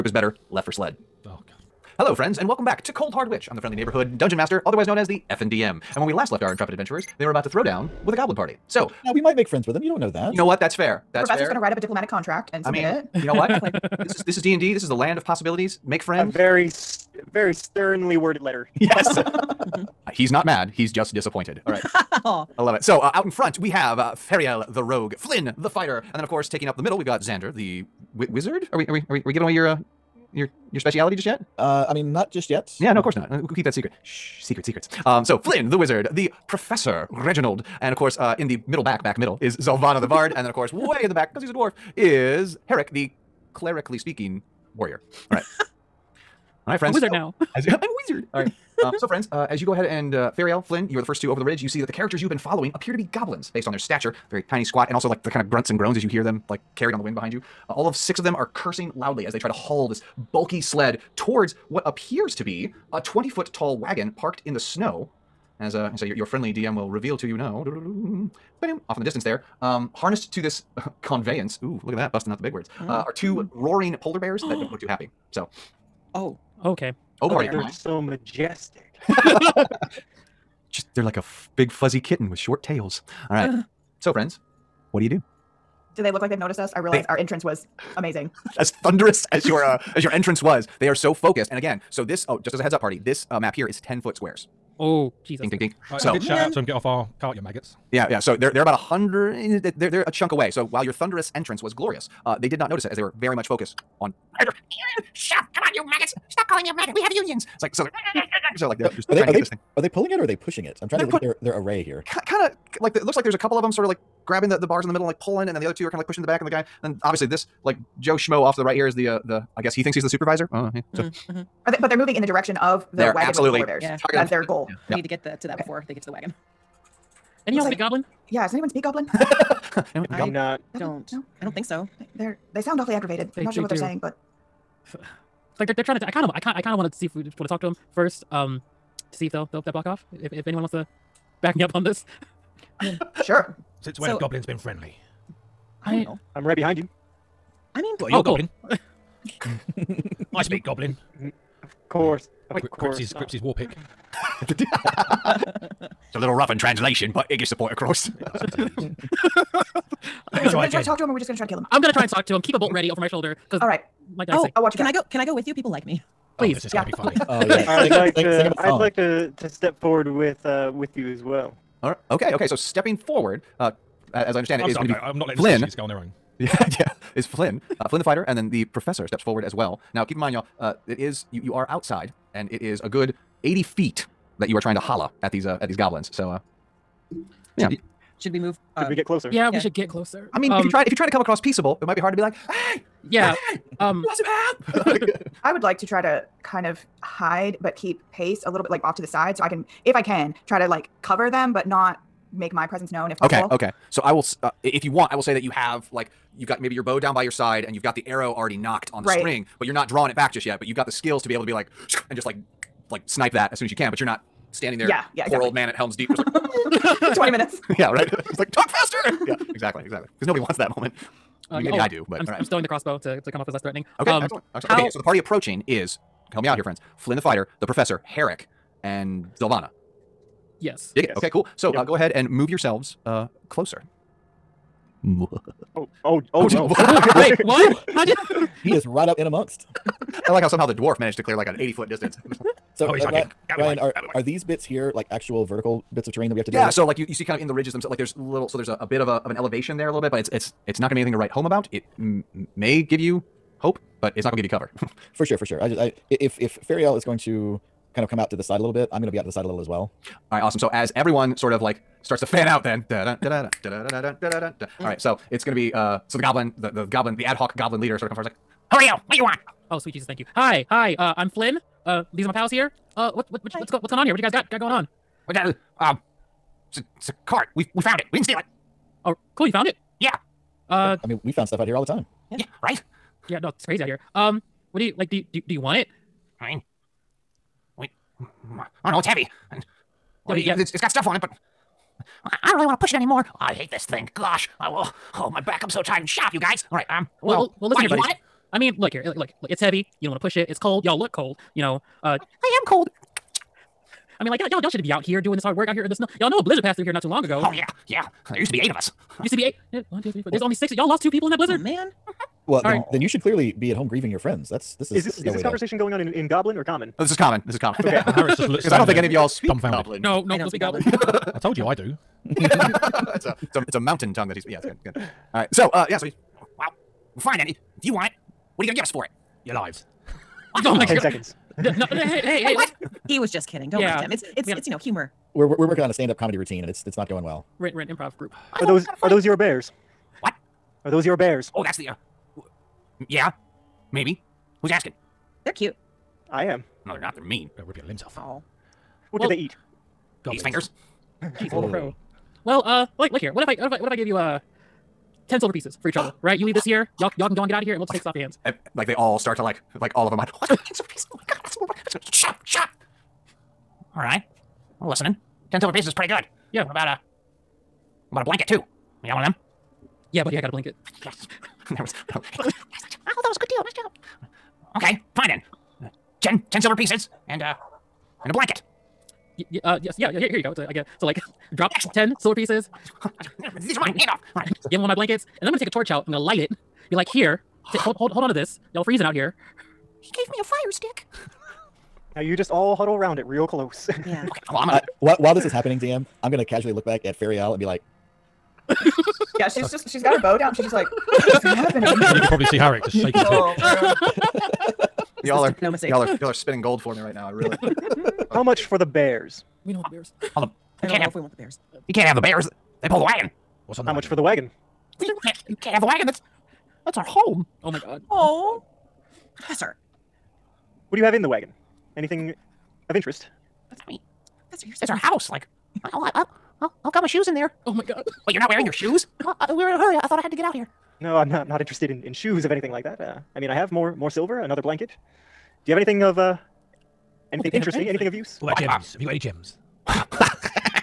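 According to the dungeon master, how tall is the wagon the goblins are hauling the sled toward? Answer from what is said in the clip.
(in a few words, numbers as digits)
20 foot.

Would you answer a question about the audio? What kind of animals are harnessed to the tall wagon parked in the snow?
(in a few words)
polar bears.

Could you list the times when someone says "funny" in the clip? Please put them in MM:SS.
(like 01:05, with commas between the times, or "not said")
02:46, 07:04.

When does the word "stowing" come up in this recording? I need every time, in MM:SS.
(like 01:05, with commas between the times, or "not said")
03:42.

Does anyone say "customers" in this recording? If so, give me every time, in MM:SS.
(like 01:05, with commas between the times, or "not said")
not said.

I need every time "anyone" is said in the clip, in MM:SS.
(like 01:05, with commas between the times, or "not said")
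02:08, 02:20.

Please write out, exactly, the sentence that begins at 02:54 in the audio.
I'm not letting Flynn the go on their own.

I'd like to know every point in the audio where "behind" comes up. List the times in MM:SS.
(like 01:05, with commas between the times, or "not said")
00:57, 02:26.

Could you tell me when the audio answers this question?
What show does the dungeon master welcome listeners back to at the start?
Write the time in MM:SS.
00:02.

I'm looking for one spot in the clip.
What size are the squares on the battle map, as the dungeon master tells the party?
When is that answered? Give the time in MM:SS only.
01:33.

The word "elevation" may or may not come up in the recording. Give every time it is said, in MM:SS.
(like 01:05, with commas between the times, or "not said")
04:09.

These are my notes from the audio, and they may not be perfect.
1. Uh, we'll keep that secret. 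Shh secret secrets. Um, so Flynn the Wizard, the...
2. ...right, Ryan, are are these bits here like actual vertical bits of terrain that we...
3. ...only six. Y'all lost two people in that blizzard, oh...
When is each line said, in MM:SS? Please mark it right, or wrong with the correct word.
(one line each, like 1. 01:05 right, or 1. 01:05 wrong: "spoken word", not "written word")
1. 00:33 right
2. 04:03 right
3. 05:10 right.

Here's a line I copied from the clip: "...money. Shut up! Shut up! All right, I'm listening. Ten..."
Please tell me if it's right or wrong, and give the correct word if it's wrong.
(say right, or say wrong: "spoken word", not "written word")
right.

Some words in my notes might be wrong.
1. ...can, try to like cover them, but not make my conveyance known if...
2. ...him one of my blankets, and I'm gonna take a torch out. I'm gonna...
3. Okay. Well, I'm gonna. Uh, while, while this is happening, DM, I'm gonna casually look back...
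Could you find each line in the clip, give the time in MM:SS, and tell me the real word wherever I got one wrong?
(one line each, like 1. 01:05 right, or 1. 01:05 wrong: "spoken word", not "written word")
1. 03:20 wrong: "presence", not "conveyance"
2. 06:24 right
3. 06:34 right.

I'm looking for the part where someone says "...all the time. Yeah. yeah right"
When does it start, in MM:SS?
04:41.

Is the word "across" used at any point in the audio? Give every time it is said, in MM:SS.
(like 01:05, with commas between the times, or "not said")
02:37, 03:11.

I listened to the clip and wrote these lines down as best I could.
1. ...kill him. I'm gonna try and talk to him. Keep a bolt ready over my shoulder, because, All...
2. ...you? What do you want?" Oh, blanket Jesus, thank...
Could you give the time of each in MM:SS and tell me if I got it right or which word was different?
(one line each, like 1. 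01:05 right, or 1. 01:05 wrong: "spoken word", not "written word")
1. 02:41 right
2. 04:28 wrong: "sweet", not "blanket".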